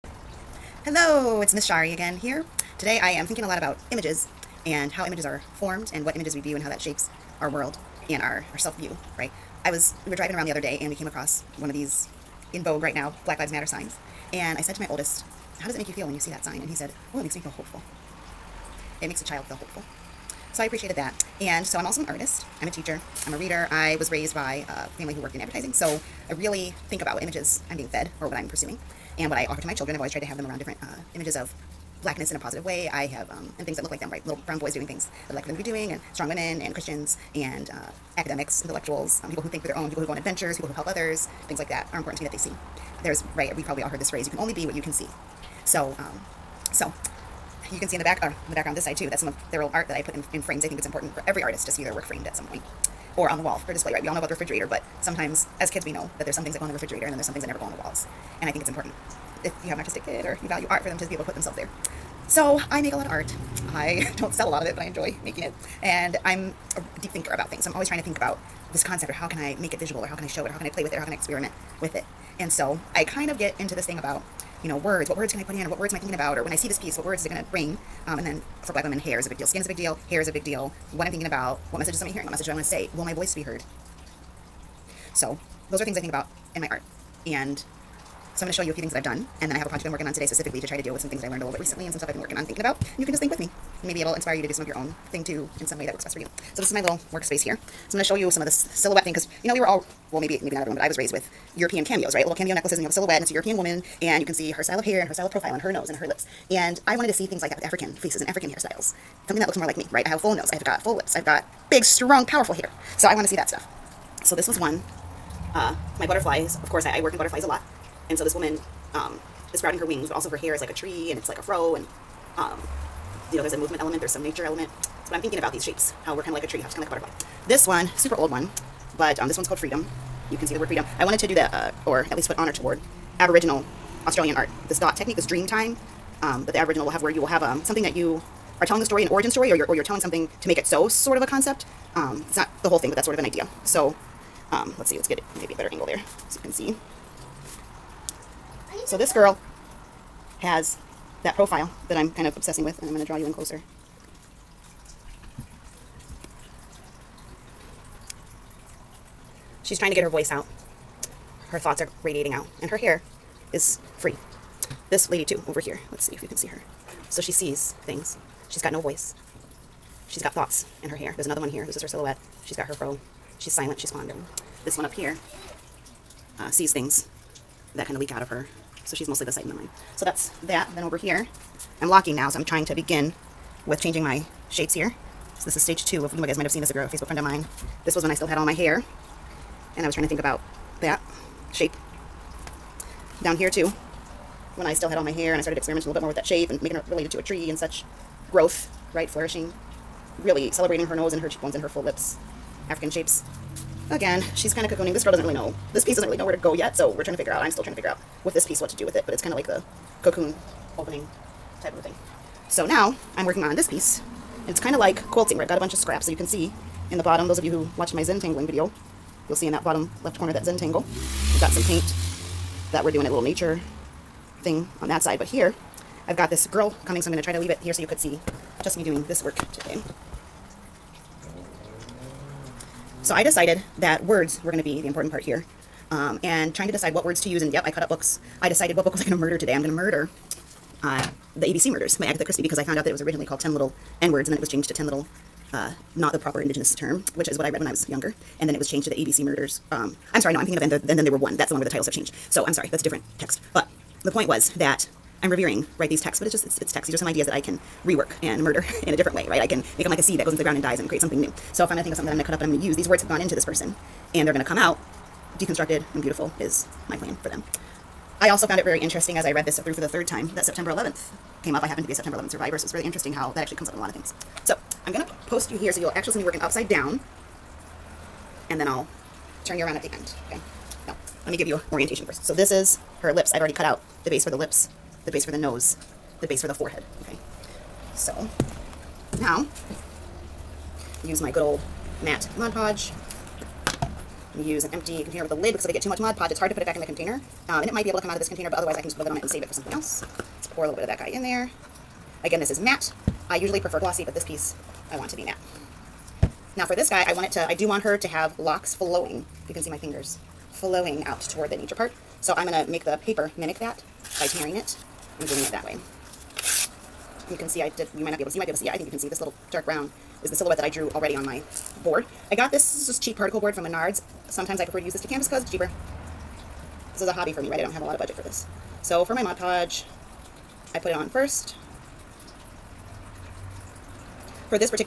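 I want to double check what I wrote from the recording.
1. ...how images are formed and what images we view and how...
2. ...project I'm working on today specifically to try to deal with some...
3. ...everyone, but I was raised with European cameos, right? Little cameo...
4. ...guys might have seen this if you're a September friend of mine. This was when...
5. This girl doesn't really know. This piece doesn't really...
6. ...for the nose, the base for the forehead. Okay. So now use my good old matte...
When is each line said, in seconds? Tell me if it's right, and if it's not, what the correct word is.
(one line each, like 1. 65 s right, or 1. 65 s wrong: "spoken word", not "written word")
1. 4 s right
2. 89 s right
3. 100 s right
4. 186 s wrong: "Facebook", not "September"
5. 204 s right
6. 285 s right.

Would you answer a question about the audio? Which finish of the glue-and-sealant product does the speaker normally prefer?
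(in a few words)
Glossy.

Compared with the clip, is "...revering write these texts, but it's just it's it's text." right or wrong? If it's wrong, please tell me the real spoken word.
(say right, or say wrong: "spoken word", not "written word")
right.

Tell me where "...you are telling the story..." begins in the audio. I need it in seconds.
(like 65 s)
137 s.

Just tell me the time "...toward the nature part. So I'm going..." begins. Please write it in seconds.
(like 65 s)
311 s.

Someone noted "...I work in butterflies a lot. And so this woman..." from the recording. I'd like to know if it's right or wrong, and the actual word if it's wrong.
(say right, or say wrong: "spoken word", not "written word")
right.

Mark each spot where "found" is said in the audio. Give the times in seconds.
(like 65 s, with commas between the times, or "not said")
242 s, 268 s.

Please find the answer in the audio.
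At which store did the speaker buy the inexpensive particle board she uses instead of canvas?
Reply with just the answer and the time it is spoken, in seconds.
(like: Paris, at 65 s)
Menards, at 323 s.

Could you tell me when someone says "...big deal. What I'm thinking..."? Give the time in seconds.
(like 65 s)
80 s.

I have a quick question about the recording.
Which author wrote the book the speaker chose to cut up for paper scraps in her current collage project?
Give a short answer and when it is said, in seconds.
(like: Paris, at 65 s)
Agatha Christie, at 242 s.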